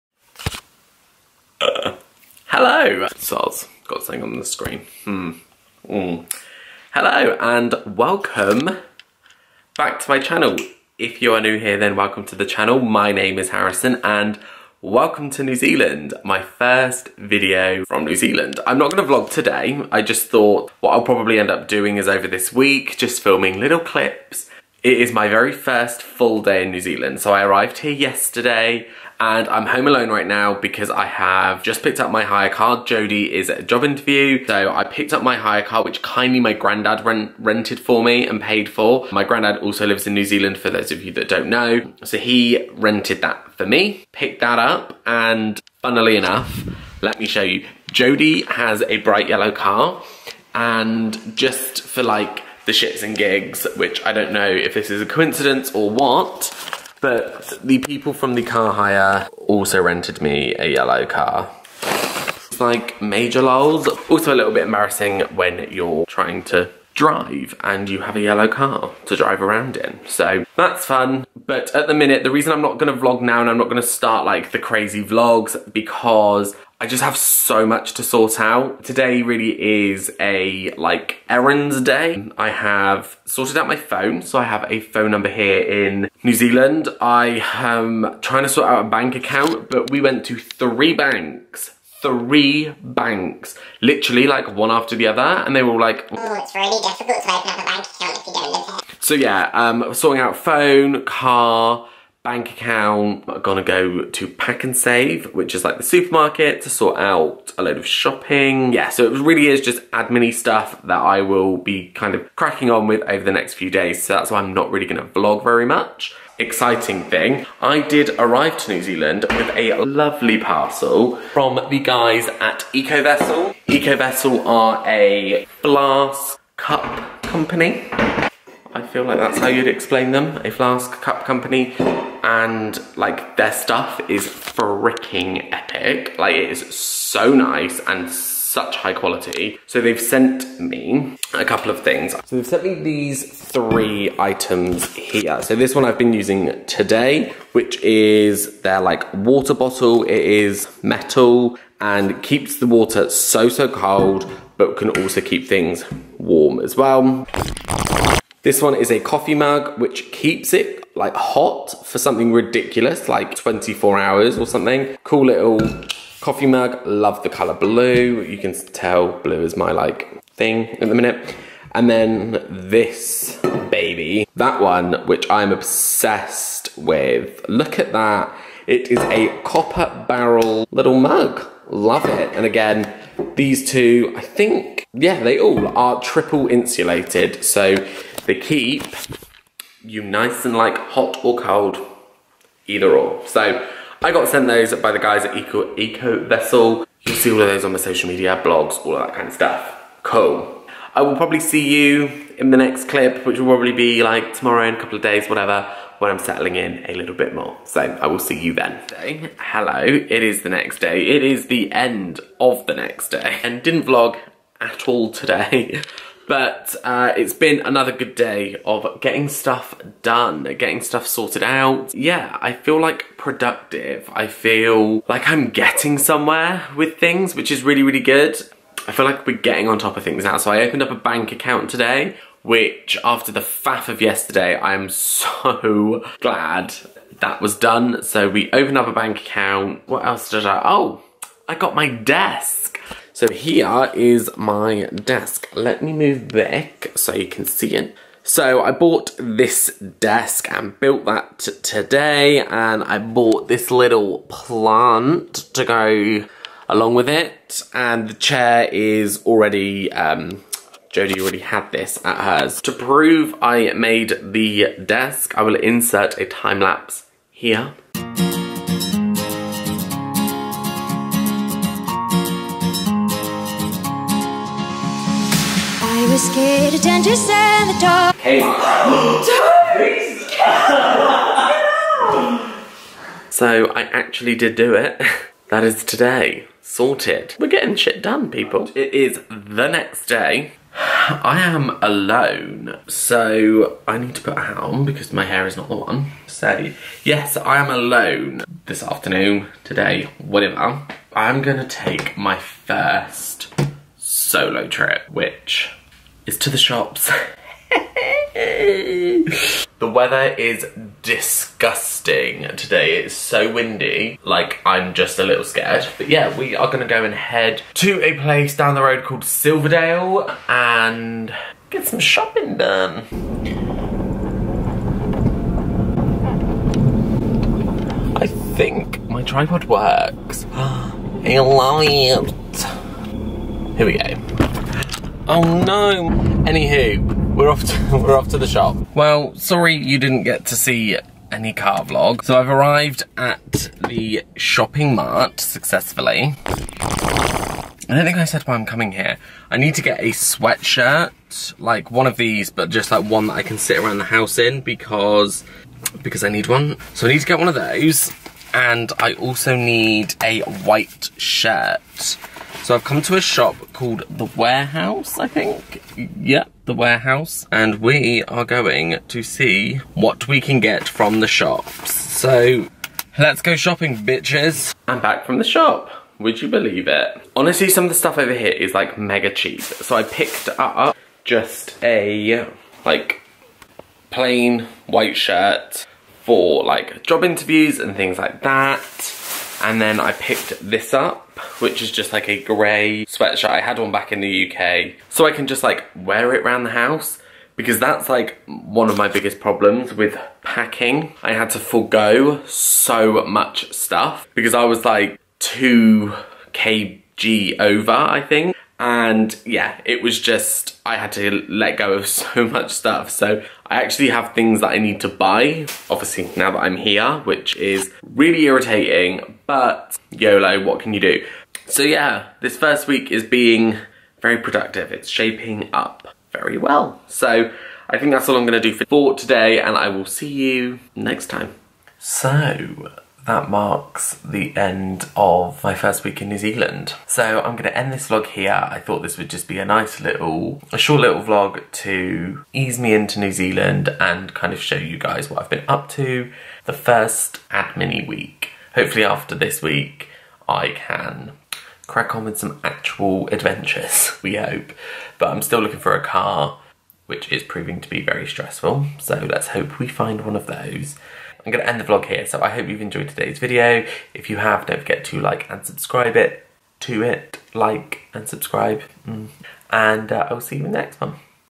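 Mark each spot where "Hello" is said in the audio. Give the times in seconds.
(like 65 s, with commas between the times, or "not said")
2 s, 6 s, 209 s.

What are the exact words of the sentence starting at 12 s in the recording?
My name is Harrison and welcome to New Zealand, my first video from New Zealand.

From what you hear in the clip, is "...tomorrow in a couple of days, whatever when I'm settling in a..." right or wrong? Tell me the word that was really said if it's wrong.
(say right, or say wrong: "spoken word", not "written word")
right.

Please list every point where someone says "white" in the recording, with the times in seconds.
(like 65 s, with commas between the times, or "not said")
360 s, 384 s.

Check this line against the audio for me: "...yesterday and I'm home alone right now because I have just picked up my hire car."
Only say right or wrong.
right.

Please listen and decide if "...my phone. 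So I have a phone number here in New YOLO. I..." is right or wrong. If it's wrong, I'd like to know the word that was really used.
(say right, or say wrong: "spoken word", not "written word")
wrong: "Zealand", not "YOLO".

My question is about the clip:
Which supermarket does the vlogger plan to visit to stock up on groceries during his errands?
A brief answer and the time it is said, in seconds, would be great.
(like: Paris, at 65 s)
PAK'nSAVE, at 104 s.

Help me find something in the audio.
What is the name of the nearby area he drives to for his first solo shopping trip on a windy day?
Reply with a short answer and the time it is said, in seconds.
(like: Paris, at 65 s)
Silverdale, at 319 s.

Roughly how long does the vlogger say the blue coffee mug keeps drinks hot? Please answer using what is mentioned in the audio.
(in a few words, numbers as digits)
24 hours.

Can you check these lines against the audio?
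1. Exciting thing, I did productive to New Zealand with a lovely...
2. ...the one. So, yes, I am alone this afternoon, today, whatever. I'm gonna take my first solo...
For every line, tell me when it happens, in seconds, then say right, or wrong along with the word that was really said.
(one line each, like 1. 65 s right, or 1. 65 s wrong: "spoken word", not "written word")
1. 116 s wrong: "arrive", not "productive"
2. 295 s right.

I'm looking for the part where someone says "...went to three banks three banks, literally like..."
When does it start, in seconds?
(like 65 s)
90 s.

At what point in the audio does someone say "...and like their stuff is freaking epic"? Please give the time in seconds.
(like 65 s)
132 s.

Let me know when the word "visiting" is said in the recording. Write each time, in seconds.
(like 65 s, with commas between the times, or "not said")
not said.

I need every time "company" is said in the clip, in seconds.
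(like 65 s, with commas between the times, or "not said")
127 s, 131 s.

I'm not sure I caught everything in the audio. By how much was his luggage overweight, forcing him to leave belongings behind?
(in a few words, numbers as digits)
2 kg.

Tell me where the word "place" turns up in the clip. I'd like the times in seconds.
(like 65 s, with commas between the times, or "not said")
318 s.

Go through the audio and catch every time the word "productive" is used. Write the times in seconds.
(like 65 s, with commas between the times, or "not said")
223 s, 424 s.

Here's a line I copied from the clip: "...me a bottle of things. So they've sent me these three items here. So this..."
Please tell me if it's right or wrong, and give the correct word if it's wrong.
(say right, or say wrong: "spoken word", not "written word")
wrong: "couple", not "bottle".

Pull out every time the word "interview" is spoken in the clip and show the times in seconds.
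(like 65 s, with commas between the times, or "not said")
33 s, 387 s.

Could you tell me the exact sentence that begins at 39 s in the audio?
My granddad also lives in New Zealand, for those of you that don't know.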